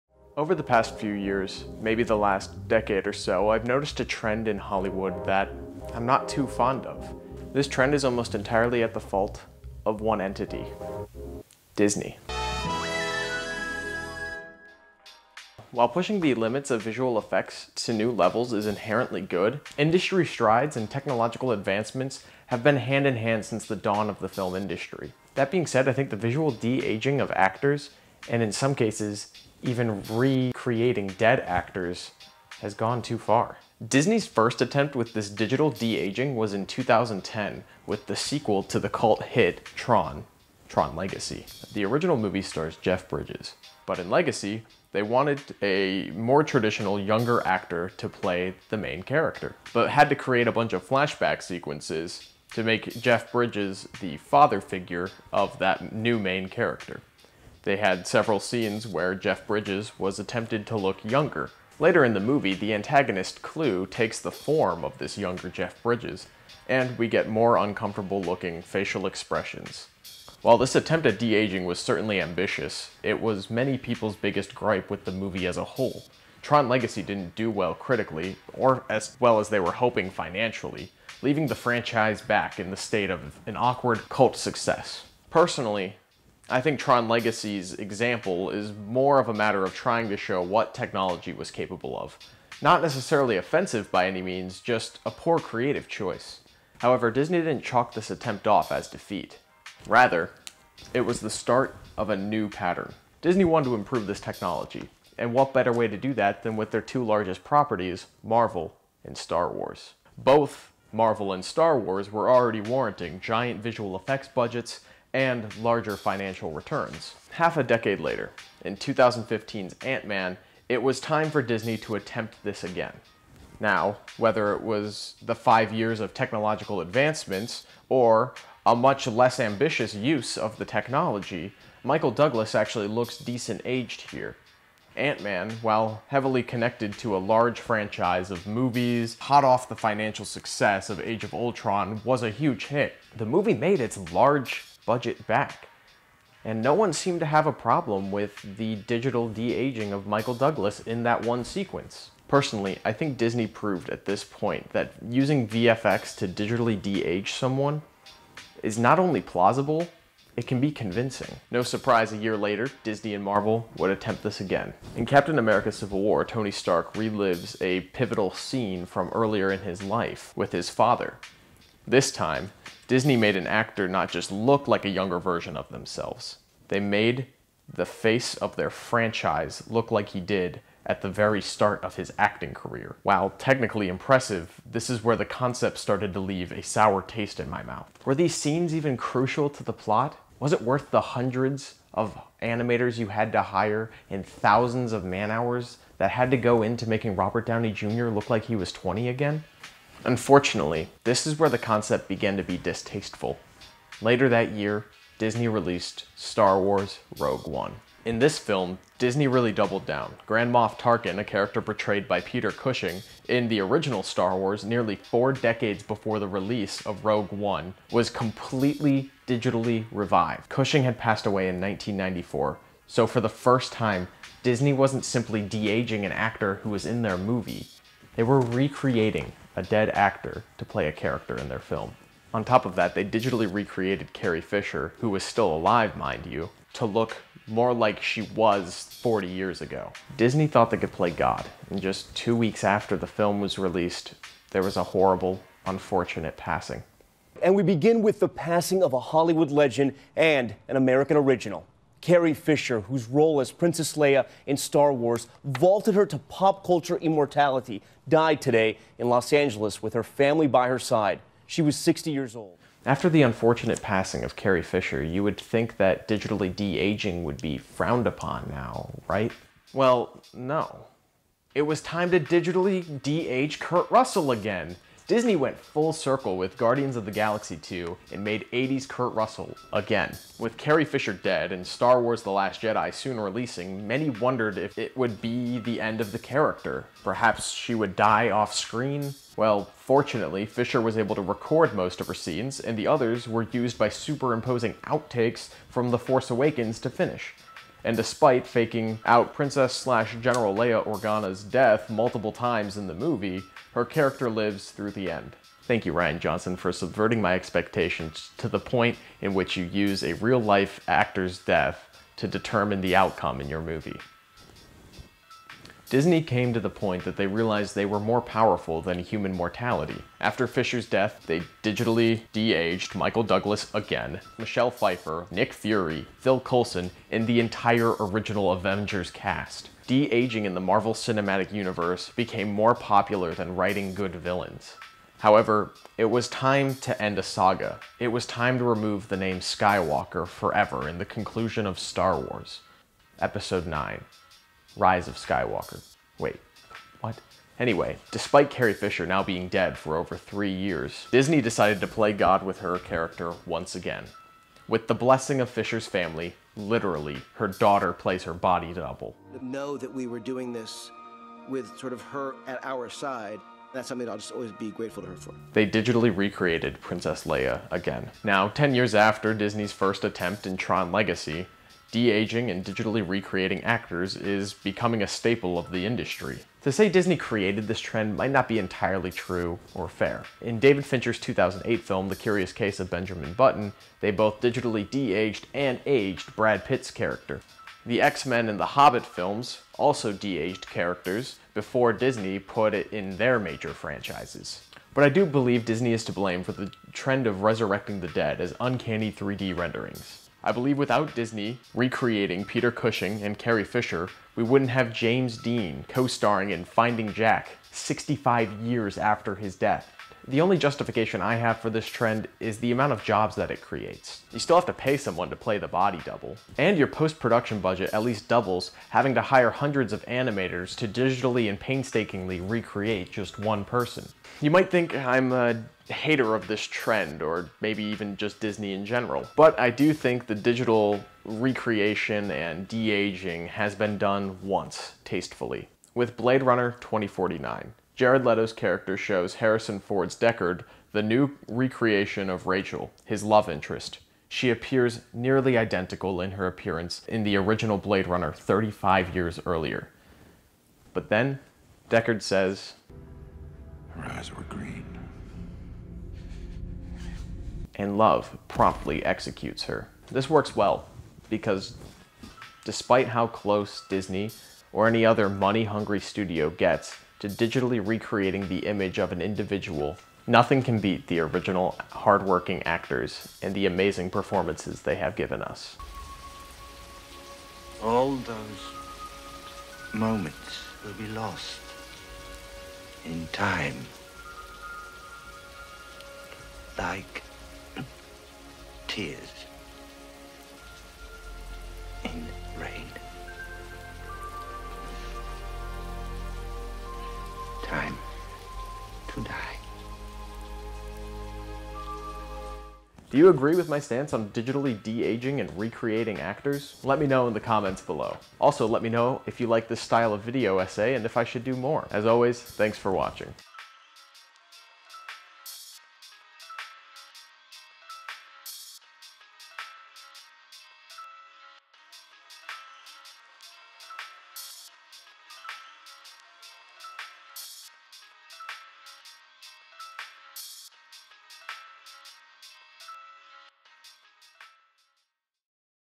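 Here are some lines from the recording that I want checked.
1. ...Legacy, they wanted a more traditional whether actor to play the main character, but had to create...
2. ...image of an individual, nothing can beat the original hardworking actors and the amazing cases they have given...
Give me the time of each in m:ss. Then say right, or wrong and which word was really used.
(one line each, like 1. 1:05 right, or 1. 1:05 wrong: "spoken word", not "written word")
1. 0:44 wrong: "younger", not "whether"
2. 7:48 wrong: "performances", not "cases".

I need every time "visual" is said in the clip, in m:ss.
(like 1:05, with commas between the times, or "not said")
0:16, 0:26, 1:53.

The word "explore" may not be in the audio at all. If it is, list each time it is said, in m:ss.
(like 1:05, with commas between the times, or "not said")
not said.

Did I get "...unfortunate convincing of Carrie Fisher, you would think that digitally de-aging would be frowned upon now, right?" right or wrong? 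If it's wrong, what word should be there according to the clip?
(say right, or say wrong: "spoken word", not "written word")
wrong: "passing", not "convincing".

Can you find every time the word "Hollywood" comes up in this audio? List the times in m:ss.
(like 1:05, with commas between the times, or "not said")
0:04, 4:08.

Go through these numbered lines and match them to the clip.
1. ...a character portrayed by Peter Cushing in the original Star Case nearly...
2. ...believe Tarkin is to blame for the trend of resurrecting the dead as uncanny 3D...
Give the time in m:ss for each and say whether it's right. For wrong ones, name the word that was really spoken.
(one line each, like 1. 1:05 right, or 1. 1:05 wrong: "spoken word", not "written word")
1. 3:31 wrong: "Wars", not "Case"
2. 6:35 wrong: "Disney", not "Tarkin".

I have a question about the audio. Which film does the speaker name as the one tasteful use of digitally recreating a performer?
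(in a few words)
Blade Runner 2049.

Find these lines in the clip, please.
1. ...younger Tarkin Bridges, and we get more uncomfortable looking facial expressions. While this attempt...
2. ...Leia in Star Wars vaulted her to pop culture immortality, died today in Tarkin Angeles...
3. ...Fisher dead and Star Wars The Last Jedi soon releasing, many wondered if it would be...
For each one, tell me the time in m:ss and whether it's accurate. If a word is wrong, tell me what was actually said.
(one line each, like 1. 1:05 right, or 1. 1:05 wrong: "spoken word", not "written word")
1. 1:05 wrong: "Jeff", not "Tarkin"
2. 4:13 wrong: "Los", not "Tarkin"
3. 4:40 right.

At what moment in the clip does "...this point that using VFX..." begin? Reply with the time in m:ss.
2:34.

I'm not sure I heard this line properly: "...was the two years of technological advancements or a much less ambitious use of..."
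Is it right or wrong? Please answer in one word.
wrong.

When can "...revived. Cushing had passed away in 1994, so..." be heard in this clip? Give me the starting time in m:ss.
3:39.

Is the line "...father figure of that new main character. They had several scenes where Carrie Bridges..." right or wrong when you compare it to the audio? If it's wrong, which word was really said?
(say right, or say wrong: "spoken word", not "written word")
wrong: "Jeff", not "Carrie".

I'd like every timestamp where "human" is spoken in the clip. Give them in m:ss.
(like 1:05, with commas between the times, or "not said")
5:18.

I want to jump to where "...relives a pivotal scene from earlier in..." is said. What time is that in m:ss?
2:46.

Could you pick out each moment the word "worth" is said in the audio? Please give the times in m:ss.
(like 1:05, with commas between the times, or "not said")
3:10.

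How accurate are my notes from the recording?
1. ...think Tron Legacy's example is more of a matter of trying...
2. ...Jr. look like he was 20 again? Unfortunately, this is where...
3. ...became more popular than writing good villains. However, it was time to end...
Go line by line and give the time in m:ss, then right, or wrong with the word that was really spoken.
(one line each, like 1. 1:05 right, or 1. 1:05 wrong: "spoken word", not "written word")
1. 1:26 right
2. 3:17 right
3. 5:32 right.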